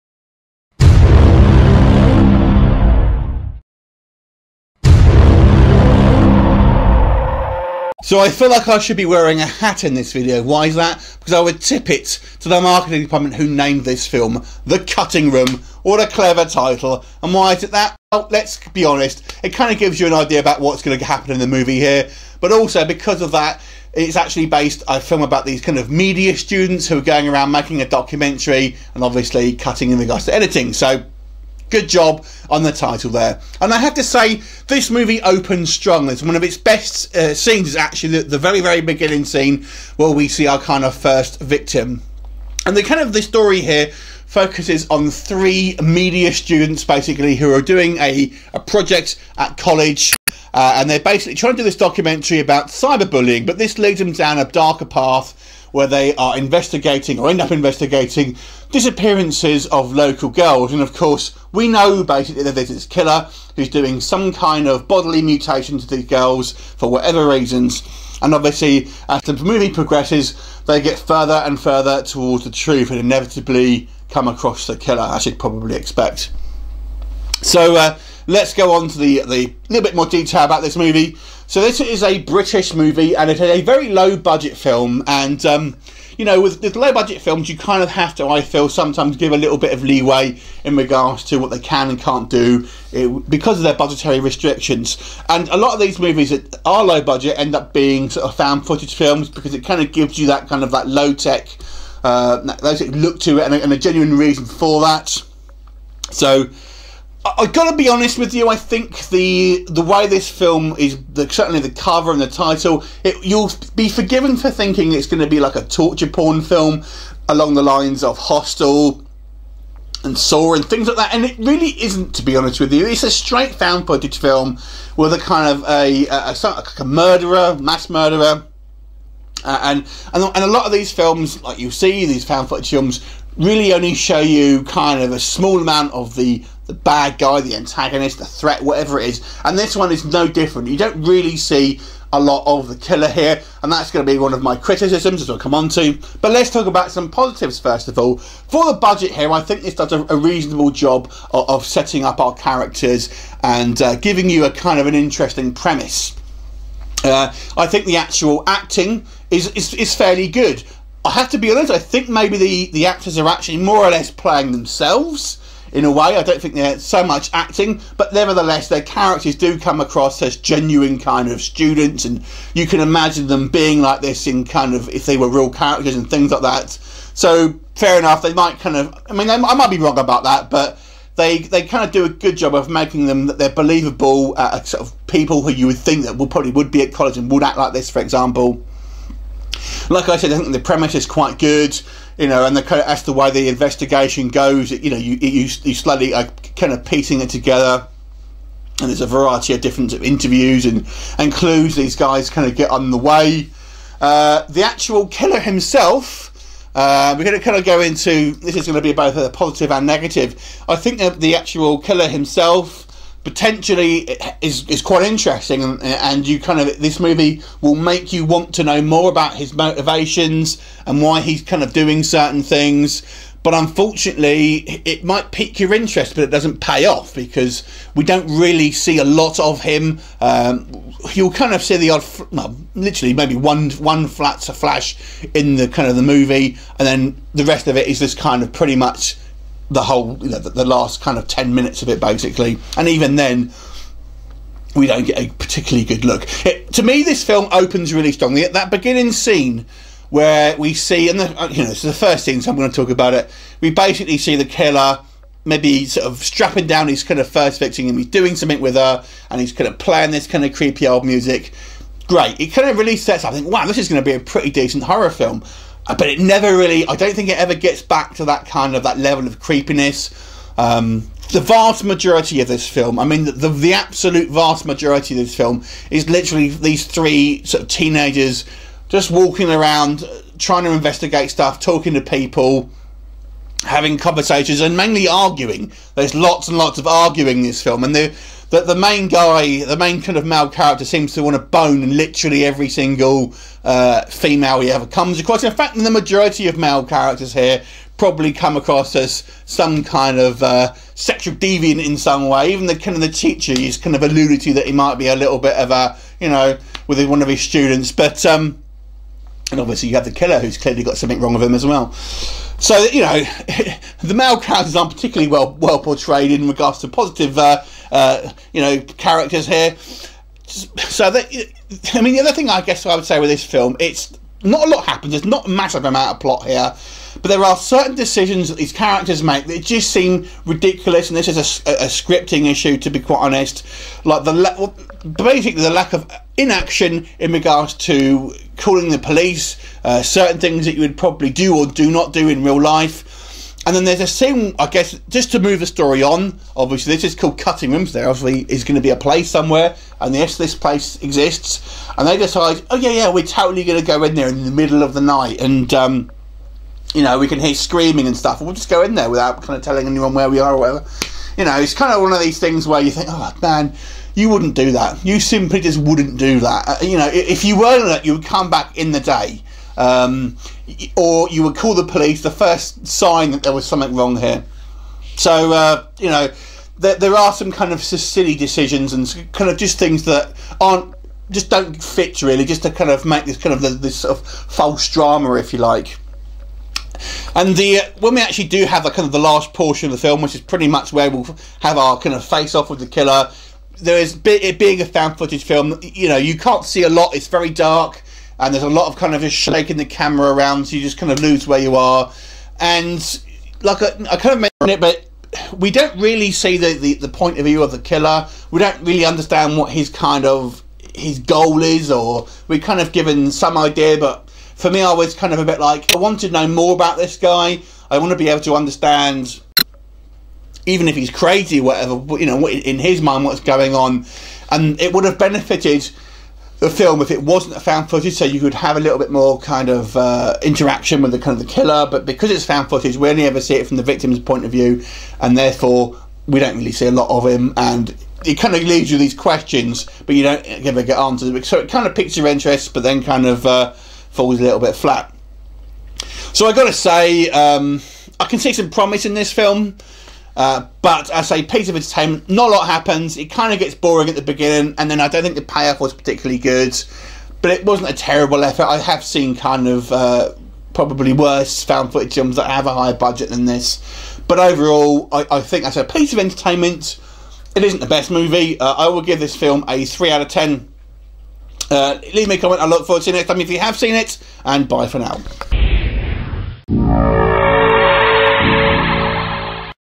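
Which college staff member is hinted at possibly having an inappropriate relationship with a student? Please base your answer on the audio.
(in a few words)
The teacher.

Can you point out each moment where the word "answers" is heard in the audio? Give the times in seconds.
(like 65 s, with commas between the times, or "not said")
440 s.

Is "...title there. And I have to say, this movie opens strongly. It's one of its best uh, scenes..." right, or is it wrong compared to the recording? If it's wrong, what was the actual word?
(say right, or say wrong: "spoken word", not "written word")
right.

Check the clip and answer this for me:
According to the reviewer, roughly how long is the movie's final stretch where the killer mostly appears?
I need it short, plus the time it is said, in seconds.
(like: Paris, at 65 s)
10 minutes, at 241 s.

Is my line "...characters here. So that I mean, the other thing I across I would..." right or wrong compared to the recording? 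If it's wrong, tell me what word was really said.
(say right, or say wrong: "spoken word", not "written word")
wrong: "guess", not "across".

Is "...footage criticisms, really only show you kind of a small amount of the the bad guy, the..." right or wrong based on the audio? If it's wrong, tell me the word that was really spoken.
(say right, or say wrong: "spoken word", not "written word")
wrong: "films", not "criticisms".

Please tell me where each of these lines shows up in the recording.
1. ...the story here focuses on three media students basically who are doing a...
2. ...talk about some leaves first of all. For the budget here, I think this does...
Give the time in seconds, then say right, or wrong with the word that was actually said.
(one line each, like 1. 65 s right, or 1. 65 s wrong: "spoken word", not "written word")
1. 43 s right
2. 146 s wrong: "positives", not "leaves".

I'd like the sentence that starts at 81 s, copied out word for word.
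So this is a British movie, and it is a very low budget film, and.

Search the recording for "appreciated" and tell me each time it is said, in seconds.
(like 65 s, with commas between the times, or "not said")
not said.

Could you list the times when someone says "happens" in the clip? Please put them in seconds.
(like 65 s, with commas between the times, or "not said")
21 s, 324 s, 452 s.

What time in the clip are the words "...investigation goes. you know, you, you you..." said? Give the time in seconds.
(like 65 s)
193 s.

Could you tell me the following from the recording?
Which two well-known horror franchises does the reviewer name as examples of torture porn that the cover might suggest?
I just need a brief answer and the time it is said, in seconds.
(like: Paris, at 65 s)
Hostel and Saw, at 118 s.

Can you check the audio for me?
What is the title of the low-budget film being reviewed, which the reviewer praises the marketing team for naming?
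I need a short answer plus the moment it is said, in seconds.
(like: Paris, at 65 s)
The Cutting Room, at 14 s.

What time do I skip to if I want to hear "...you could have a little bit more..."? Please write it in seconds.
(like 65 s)
428 s.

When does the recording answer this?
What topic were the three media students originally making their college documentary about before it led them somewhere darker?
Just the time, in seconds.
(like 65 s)
52 s.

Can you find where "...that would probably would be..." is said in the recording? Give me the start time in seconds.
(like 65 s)
186 s.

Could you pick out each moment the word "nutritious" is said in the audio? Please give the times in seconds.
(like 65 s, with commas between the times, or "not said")
not said.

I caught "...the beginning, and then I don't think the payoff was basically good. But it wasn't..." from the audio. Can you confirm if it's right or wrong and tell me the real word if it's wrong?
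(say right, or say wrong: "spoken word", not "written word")
wrong: "particularly", not "basically".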